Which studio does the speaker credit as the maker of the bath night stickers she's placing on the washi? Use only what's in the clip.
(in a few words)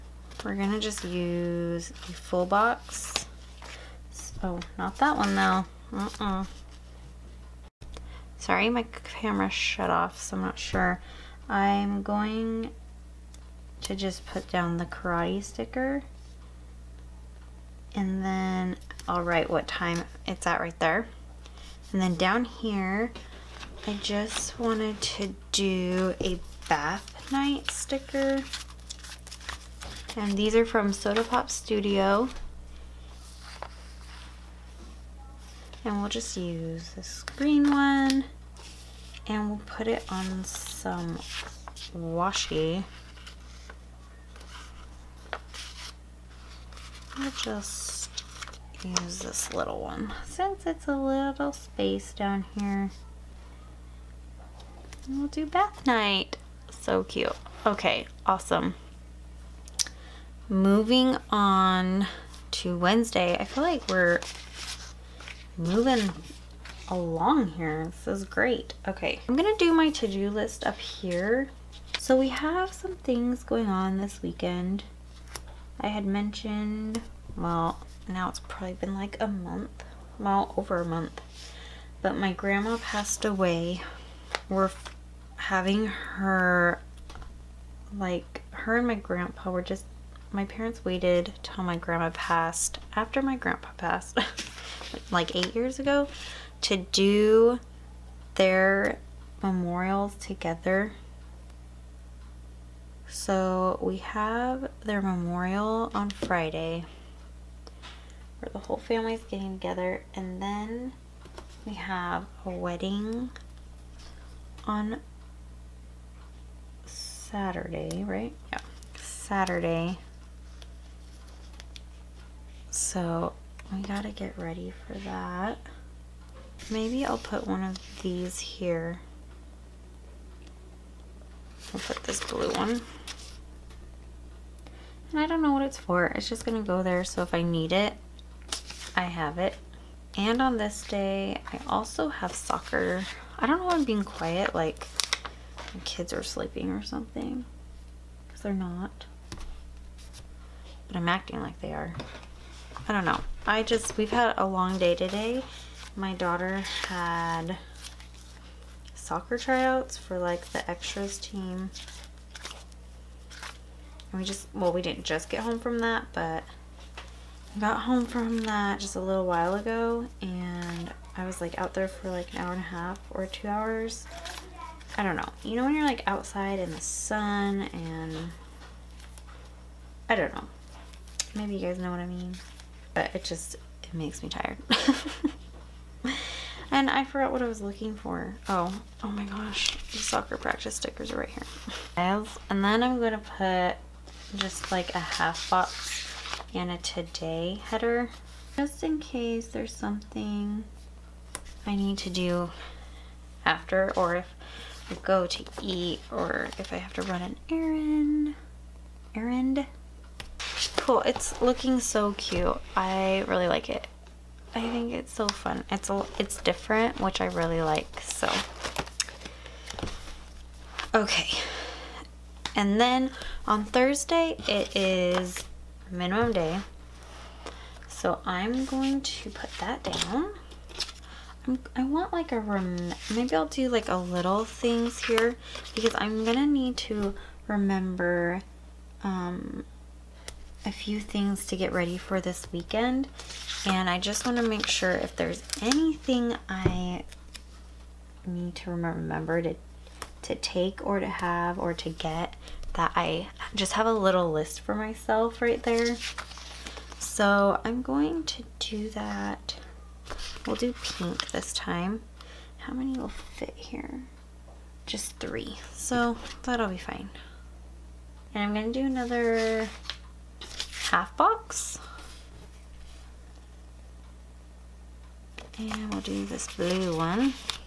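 Soda Pop Studio.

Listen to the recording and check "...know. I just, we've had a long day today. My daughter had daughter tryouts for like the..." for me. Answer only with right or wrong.
wrong.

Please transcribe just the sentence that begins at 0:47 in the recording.
i will just use this little one since it's a little space down here.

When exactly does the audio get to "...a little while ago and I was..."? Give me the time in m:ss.
2:48.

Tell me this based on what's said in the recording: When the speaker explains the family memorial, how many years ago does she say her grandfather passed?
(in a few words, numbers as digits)
8.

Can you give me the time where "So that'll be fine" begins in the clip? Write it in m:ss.
4:25.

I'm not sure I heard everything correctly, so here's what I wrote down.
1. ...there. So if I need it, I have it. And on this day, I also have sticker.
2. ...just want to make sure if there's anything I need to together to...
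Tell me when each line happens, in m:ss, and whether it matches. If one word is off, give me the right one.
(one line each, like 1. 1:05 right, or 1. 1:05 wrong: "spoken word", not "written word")
1. 2:16 wrong: "soccer", not "sticker"
2. 4:03 wrong: "remember", not "together".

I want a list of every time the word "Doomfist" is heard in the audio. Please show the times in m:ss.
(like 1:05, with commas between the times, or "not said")
not said.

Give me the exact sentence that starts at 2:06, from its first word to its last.
Maybe I'll put one of these here.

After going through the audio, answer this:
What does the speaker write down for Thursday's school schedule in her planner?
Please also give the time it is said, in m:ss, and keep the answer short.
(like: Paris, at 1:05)
Minimum day, at 3:45.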